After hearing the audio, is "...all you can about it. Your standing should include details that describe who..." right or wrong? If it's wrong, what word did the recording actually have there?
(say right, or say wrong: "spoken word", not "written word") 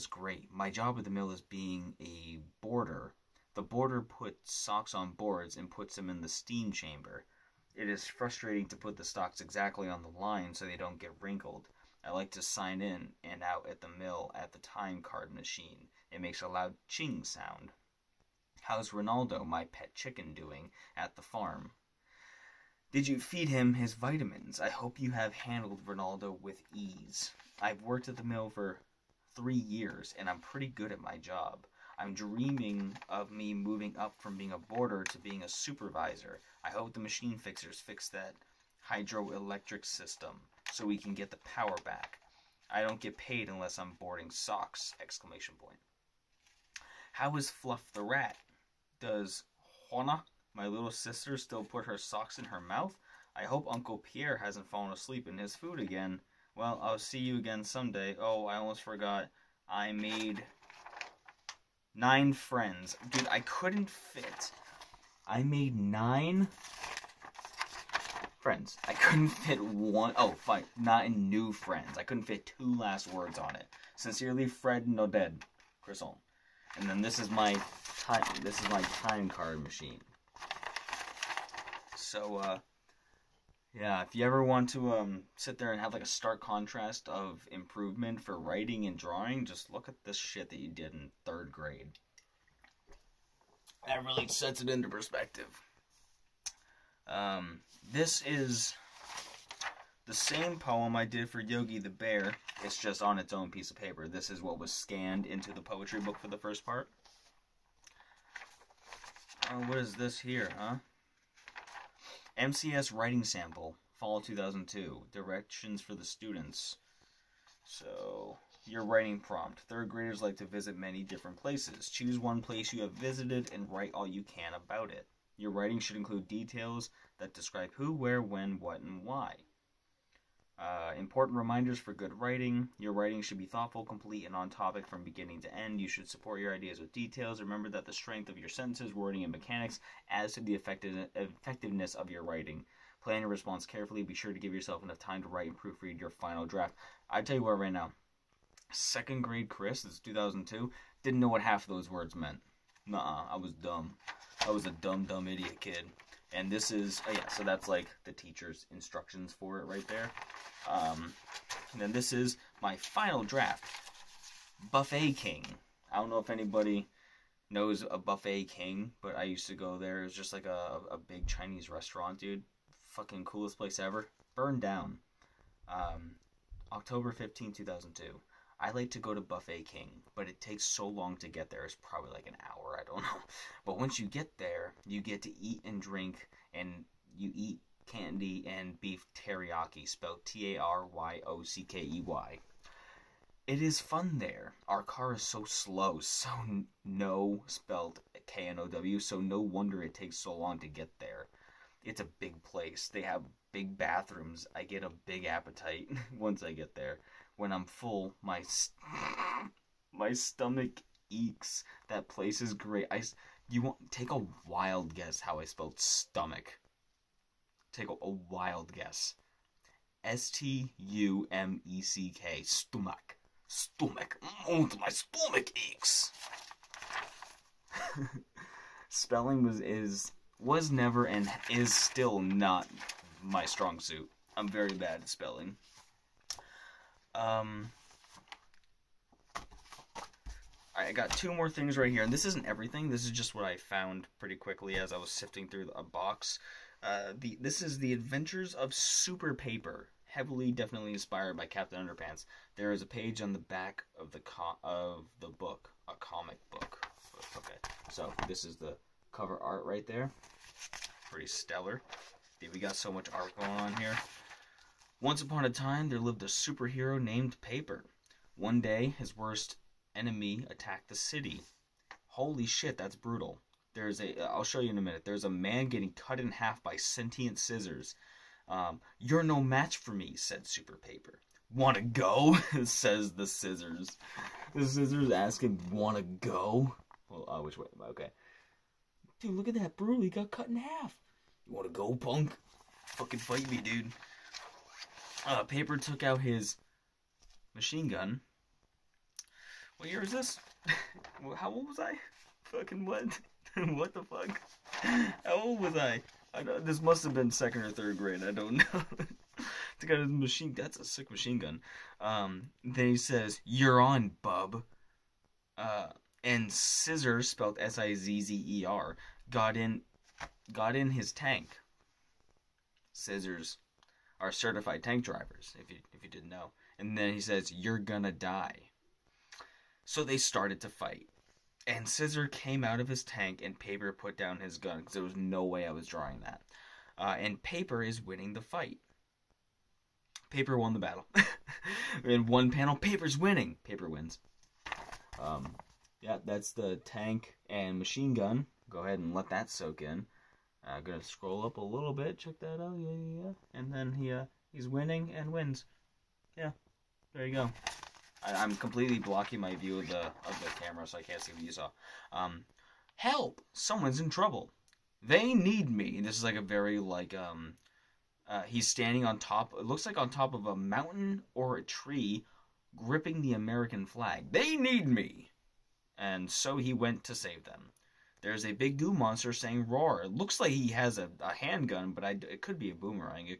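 wrong: "writing", not "standing".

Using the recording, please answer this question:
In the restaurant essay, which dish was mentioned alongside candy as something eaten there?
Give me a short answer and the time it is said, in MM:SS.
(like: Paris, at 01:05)
Beef teriyaki, at 03:08.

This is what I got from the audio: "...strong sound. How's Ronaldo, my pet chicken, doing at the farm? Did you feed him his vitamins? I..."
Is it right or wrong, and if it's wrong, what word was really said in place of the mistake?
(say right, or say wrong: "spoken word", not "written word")
wrong: "ching", not "strong".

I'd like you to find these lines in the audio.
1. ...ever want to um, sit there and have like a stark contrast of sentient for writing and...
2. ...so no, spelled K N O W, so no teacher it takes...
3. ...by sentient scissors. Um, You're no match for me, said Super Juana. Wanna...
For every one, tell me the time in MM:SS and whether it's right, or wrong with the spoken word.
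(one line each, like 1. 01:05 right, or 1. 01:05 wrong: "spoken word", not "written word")
1. 01:24 wrong: "improvement", not "sentient"
2. 03:16 wrong: "wonder", not "teacher"
3. 04:36 wrong: "Paper", not "Juana".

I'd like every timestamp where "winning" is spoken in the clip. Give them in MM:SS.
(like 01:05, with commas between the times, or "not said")
05:38, 05:43, 05:54.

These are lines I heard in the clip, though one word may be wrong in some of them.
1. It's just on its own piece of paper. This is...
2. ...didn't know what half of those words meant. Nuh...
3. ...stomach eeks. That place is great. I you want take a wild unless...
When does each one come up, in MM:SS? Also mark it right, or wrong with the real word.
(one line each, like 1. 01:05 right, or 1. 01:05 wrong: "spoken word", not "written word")
1. 01:42 right
2. 02:31 right
3. 03:30 wrong: "guess", not "unless".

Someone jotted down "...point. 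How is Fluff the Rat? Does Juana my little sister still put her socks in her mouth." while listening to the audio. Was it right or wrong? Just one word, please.
right.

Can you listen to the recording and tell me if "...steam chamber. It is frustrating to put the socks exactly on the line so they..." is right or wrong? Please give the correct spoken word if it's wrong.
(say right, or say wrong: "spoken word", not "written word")
right.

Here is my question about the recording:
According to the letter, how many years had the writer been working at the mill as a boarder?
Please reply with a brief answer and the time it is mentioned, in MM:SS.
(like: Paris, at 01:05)
3, at 00:29.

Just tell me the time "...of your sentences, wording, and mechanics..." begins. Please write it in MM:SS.
02:18.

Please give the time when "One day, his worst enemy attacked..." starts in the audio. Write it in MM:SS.
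04:28.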